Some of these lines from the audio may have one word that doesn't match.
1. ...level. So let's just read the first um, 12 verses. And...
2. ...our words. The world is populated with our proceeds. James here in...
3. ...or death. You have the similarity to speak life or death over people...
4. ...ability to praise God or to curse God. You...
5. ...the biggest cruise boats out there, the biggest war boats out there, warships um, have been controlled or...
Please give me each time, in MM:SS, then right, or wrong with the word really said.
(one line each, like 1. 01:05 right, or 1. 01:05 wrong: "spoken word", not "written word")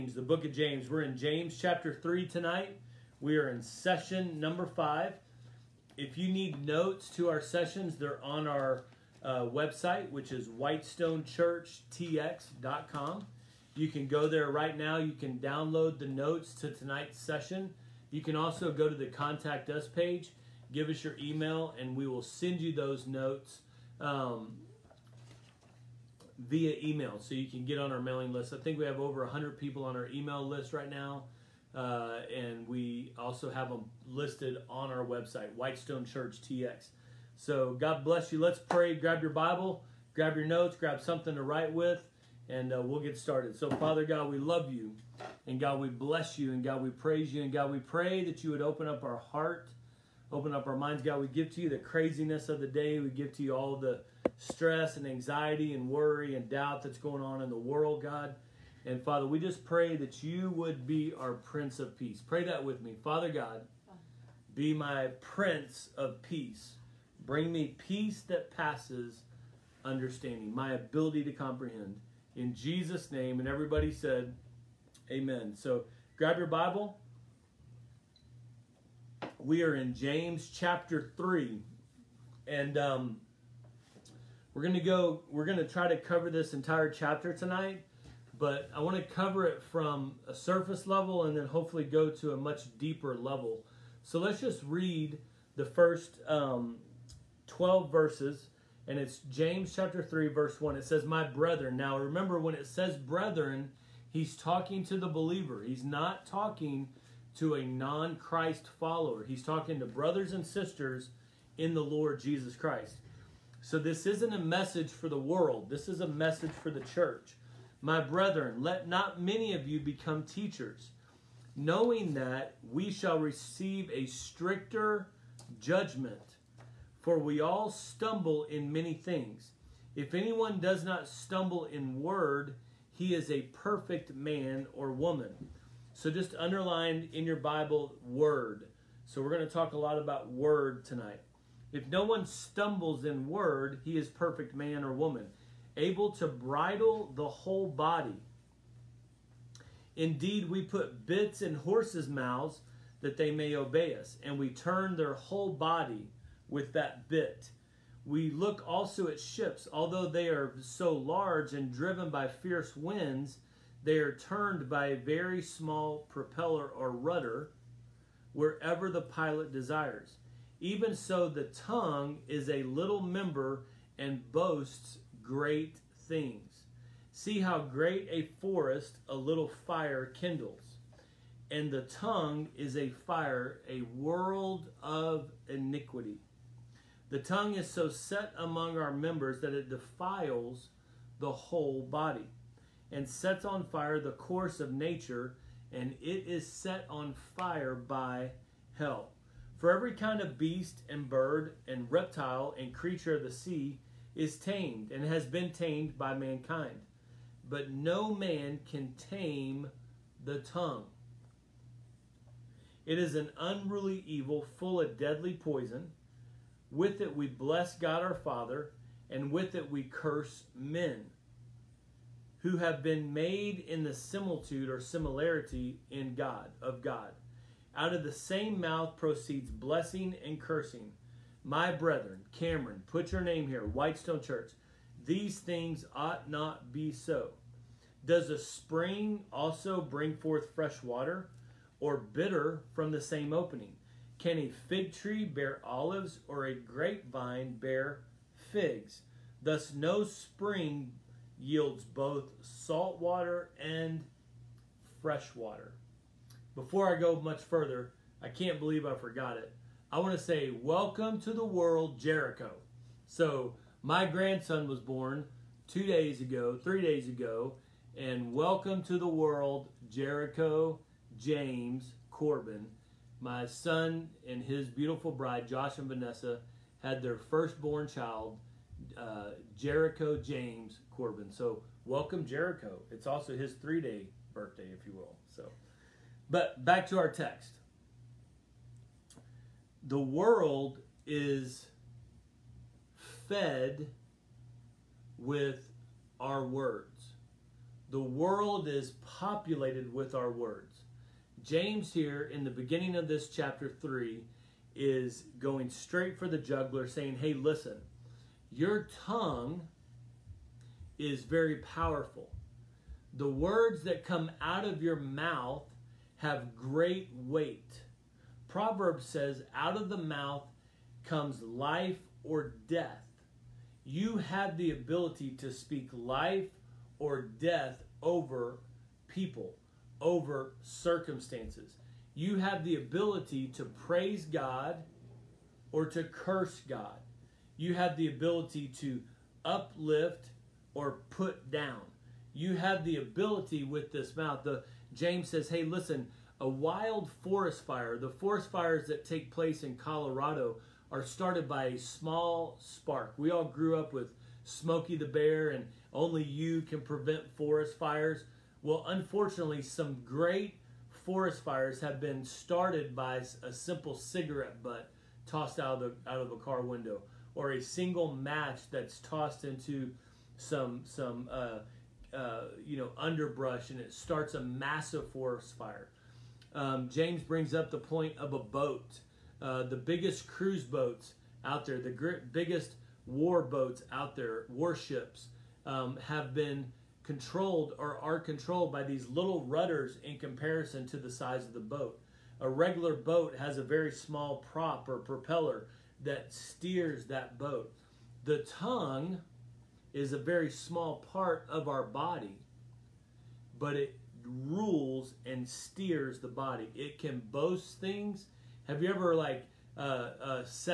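1. 01:33 right
2. 04:56 wrong: "words", not "proceeds"
3. 05:22 wrong: "ability", not "similarity"
4. 05:32 right
5. 06:19 right.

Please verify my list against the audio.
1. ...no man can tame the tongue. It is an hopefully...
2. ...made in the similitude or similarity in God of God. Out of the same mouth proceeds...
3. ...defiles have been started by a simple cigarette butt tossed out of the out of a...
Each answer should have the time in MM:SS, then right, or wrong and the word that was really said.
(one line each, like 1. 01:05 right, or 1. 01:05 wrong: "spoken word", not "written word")
1. 03:27 wrong: "unruly", not "hopefully"
2. 03:43 right
3. 06:01 wrong: "fires", not "defiles".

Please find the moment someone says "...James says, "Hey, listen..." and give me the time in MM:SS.
05:44.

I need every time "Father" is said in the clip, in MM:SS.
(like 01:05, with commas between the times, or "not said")
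00:43, 00:59, 01:03, 03:38.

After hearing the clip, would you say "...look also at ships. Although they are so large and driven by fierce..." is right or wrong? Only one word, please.
right.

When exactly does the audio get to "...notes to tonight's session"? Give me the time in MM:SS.
00:16.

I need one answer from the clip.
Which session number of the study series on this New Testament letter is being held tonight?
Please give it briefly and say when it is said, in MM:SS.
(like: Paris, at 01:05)
5, at 00:03.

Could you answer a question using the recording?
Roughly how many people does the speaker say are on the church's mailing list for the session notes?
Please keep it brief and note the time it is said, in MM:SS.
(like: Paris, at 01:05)
over 100, at 00:28.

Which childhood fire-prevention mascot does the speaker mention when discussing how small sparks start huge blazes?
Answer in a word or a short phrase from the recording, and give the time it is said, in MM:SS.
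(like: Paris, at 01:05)
Smokey the Bear, at 05:54.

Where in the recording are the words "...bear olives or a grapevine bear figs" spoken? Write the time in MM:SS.
04:05.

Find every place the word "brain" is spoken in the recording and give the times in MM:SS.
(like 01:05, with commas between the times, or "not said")
not said.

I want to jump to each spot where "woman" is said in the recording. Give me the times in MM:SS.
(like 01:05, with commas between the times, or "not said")
02:14, 02:24.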